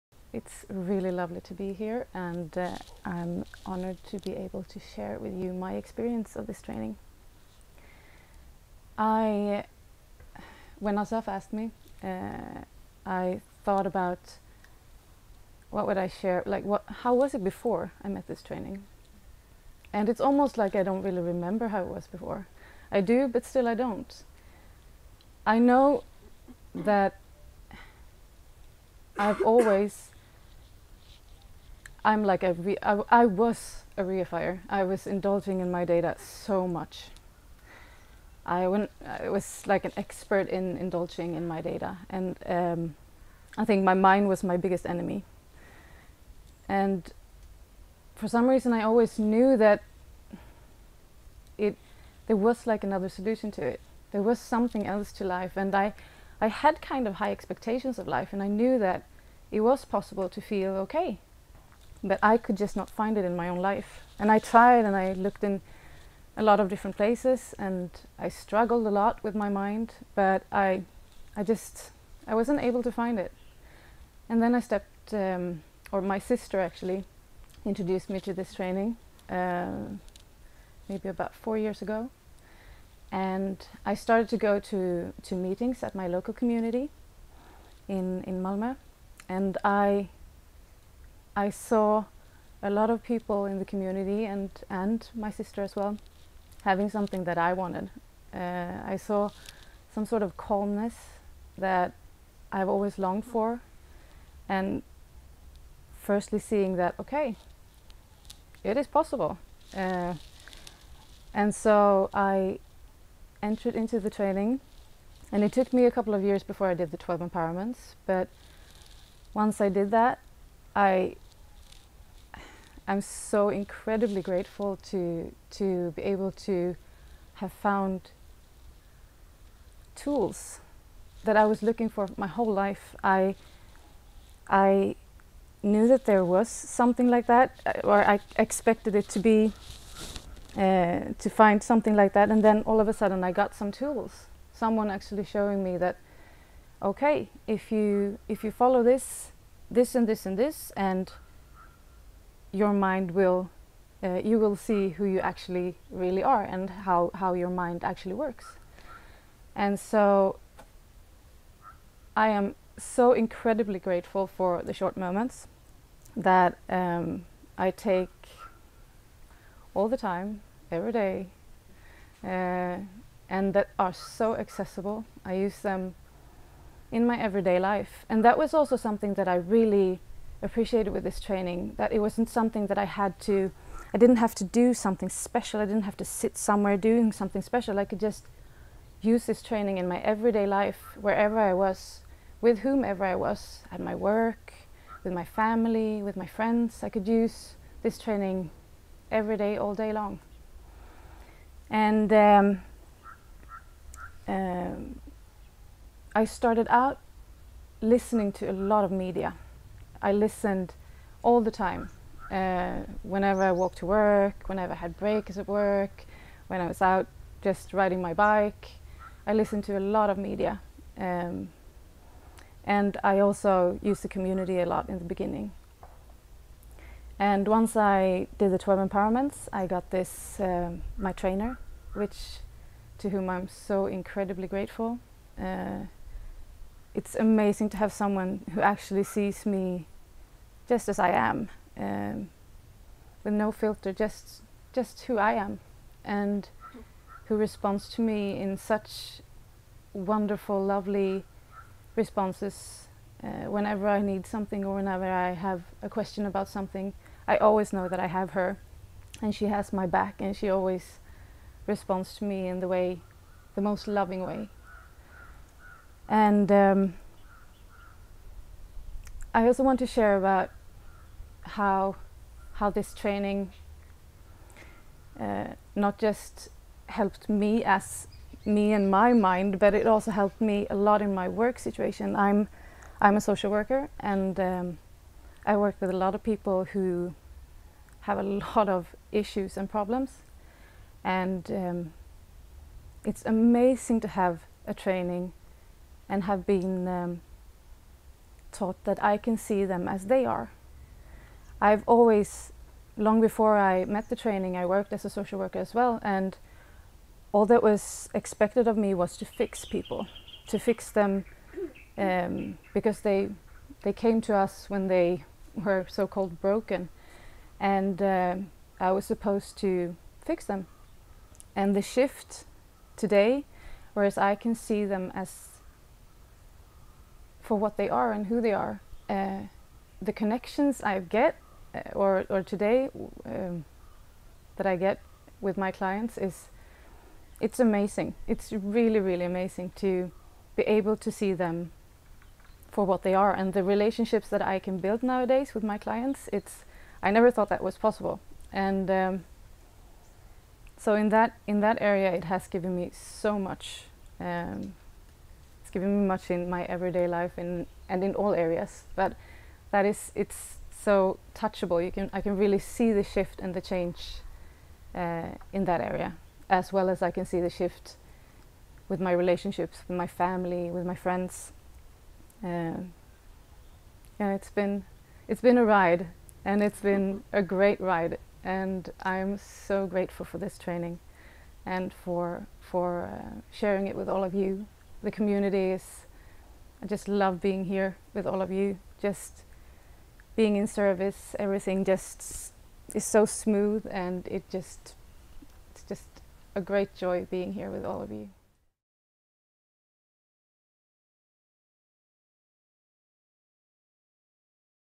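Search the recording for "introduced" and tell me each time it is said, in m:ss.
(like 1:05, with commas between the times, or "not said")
1:17.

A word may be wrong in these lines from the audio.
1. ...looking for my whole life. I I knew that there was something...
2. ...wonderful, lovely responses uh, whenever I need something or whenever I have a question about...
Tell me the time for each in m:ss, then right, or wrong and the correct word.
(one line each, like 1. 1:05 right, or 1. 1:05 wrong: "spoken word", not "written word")
1. 2:11 right
2. 4:09 right.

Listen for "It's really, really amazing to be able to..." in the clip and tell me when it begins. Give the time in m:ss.
5:38.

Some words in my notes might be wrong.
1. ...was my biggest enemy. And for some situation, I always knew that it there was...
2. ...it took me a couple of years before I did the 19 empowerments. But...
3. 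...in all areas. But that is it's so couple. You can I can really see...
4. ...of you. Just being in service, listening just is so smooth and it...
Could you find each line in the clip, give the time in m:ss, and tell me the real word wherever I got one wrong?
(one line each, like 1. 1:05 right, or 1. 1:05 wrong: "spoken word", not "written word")
1. 0:44 wrong: "reason", not "situation"
2. 1:55 wrong: "12", not "19"
3. 5:58 wrong: "touchable", not "couple"
4. 6:28 wrong: "everything", not "listening".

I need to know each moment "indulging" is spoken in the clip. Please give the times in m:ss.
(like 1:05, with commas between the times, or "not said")
0:35, 0:40.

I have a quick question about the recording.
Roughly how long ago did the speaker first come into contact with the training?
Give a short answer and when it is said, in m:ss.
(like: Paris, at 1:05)
About 4 years ago, at 1:21.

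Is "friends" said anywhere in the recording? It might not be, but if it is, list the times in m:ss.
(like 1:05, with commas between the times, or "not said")
3:16, 6:10.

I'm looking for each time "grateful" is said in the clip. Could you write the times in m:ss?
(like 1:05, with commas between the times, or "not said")
2:04, 2:43, 3:54, 6:19.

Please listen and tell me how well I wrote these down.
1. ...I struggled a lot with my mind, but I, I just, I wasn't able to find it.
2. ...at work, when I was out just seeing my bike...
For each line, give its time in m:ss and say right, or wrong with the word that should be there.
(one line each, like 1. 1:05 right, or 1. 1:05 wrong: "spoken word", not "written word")
1. 1:08 right
2. 3:35 wrong: "riding", not "seeing".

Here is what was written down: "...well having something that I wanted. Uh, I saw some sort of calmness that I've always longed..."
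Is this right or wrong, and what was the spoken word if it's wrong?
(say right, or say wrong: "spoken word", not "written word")
right.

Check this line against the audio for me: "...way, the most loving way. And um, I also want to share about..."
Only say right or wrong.
right.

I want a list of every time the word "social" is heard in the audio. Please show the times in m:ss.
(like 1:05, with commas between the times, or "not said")
4:43, 5:05.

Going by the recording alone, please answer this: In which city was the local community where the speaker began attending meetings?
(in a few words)
Malmö.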